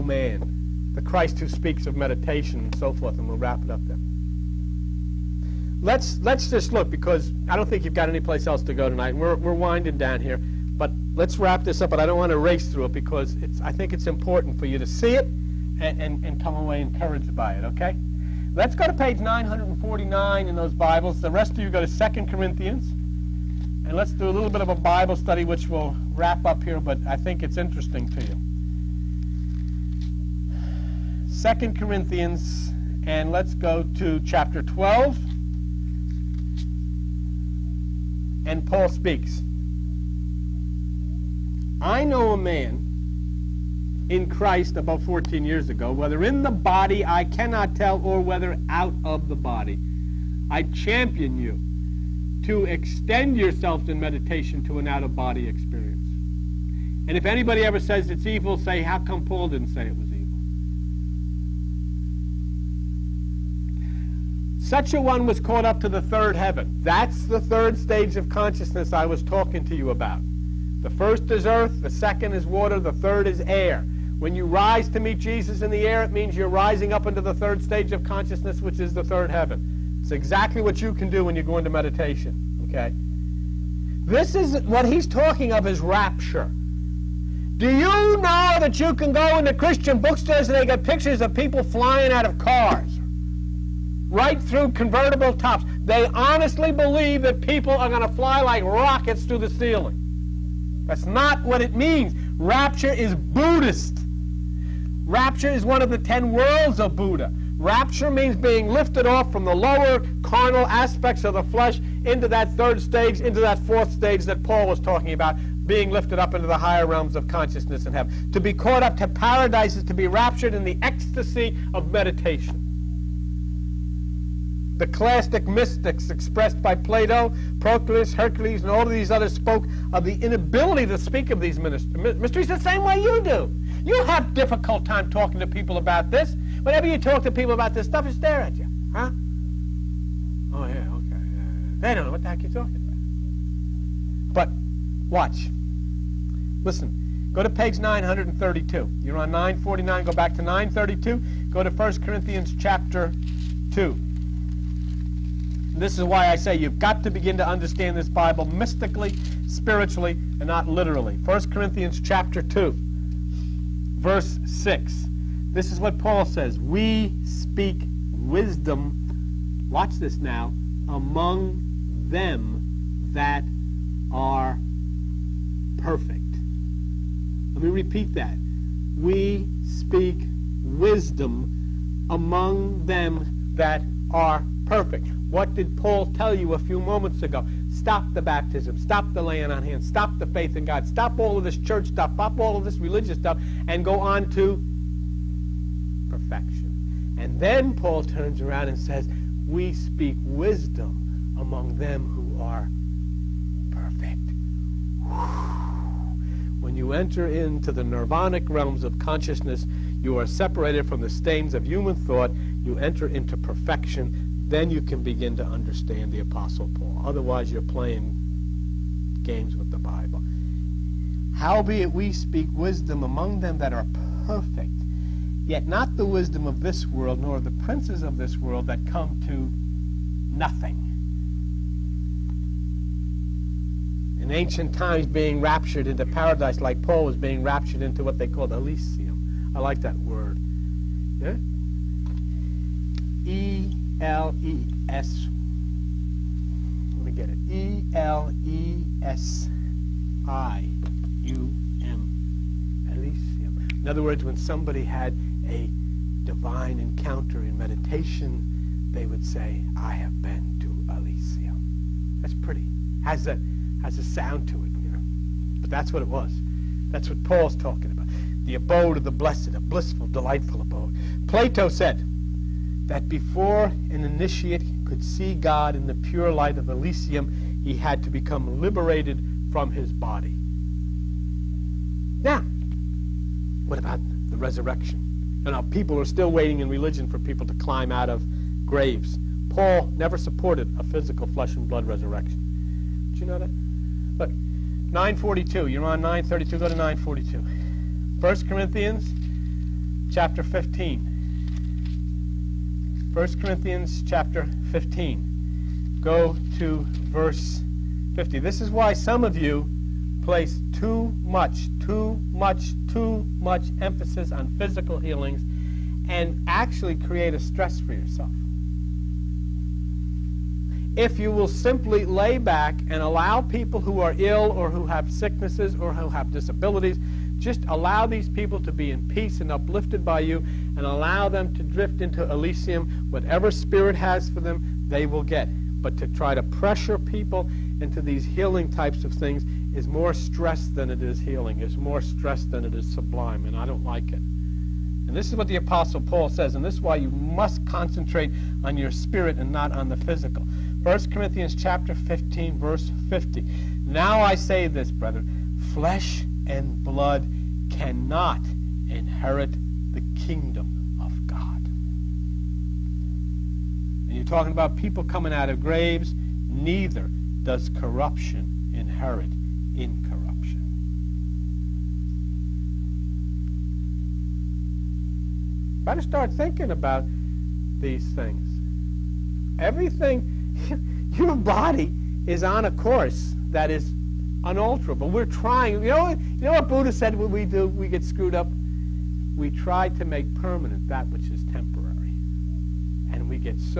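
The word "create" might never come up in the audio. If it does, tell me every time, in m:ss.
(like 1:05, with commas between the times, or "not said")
5:16.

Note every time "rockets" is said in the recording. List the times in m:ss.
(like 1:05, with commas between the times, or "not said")
1:38.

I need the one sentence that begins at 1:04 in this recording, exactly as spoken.
Such a one was caught up to the third heaven.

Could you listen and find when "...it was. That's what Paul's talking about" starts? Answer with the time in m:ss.
4:26.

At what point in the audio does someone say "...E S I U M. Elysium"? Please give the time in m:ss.
4:08.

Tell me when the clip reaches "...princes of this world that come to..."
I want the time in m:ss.
3:47.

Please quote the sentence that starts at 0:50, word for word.
I champion you to extend yourselves in meditation to an out of body experience.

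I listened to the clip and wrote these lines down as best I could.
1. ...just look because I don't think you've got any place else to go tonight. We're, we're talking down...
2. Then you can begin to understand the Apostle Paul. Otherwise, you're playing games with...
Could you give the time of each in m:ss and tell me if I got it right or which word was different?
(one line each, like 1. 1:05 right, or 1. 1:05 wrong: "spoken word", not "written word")
1. 0:06 wrong: "winding", not "talking"
2. 3:34 right.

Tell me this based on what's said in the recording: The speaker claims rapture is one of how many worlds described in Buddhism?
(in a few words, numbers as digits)
10.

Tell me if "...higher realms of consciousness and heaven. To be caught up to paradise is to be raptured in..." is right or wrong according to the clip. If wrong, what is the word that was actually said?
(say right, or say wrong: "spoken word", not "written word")
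right.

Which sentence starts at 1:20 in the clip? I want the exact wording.
It's exactly what you can do when you go into meditation, okay?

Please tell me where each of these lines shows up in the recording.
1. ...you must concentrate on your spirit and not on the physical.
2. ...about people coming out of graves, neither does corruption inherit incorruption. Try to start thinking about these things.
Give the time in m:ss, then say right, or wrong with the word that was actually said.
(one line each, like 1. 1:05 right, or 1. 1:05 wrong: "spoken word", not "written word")
1. 5:46 right
2. 6:04 right.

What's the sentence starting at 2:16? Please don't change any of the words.
Whenever you talk to people about this stuff, they stare at you.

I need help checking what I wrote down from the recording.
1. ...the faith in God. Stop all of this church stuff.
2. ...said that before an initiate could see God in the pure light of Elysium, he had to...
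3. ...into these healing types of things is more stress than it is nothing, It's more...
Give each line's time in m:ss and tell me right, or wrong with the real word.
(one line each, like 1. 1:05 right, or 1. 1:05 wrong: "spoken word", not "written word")
1. 3:10 right
2. 4:31 right
3. 5:37 wrong: "healing", not "nothing".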